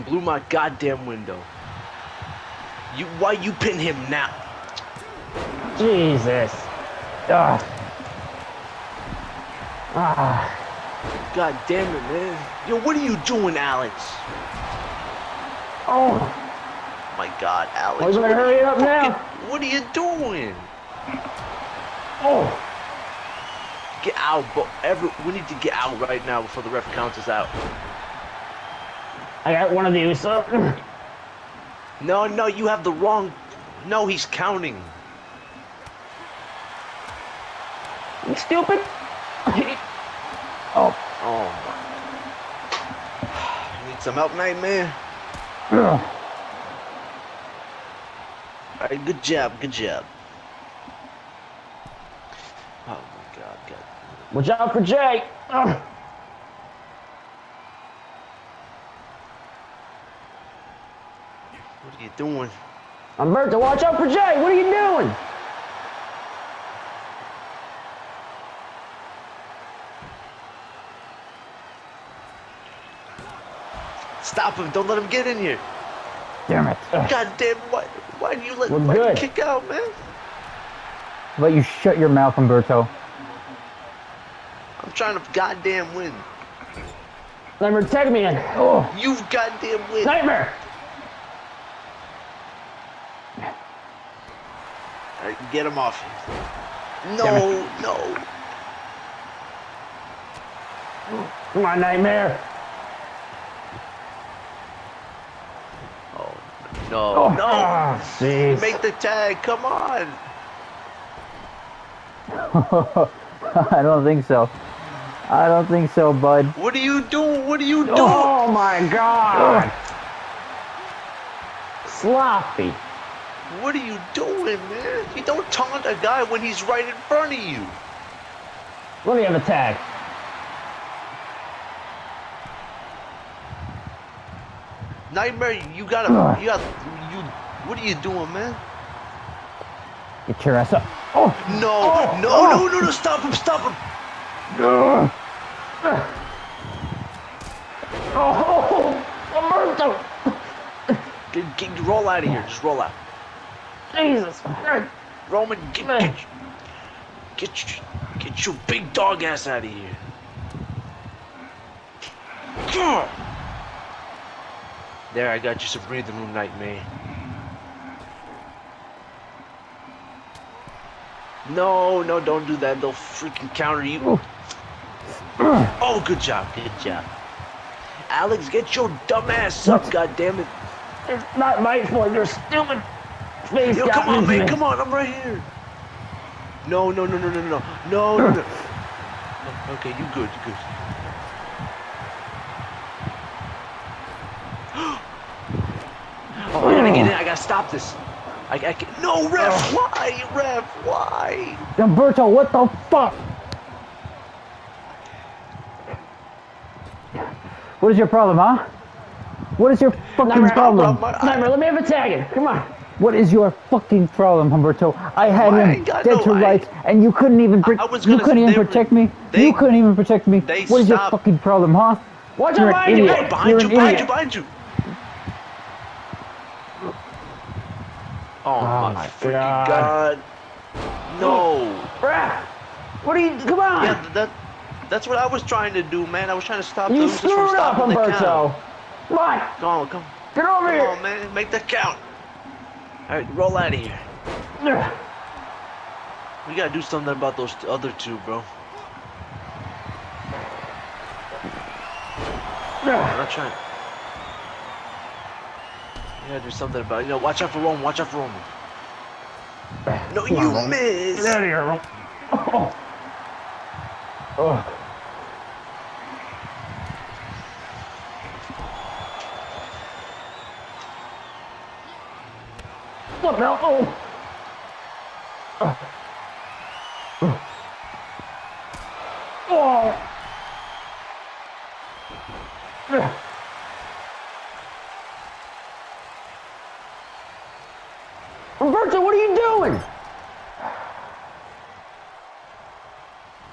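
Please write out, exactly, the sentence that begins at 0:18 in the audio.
Why to hurry up fucking, now?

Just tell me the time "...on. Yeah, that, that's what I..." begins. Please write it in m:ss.
3:53.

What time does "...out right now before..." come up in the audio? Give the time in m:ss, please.
0:25.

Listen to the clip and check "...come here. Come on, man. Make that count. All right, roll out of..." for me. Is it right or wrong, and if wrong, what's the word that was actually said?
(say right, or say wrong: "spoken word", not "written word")
right.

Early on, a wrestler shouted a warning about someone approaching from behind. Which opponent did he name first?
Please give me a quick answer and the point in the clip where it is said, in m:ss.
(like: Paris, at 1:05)
Jake, at 0:54.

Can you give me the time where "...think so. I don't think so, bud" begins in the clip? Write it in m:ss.
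1:54.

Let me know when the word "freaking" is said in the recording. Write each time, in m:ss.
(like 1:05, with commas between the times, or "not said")
2:52, 3:49.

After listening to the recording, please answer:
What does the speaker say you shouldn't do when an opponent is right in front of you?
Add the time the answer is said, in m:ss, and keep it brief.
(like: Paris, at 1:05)
taunt, at 2:05.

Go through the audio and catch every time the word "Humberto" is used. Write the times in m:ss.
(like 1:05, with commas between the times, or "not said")
1:22, 3:21, 3:34, 3:57.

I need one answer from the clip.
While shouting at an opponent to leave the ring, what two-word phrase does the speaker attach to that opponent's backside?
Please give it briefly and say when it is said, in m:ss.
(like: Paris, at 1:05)
big dog, at 2:38.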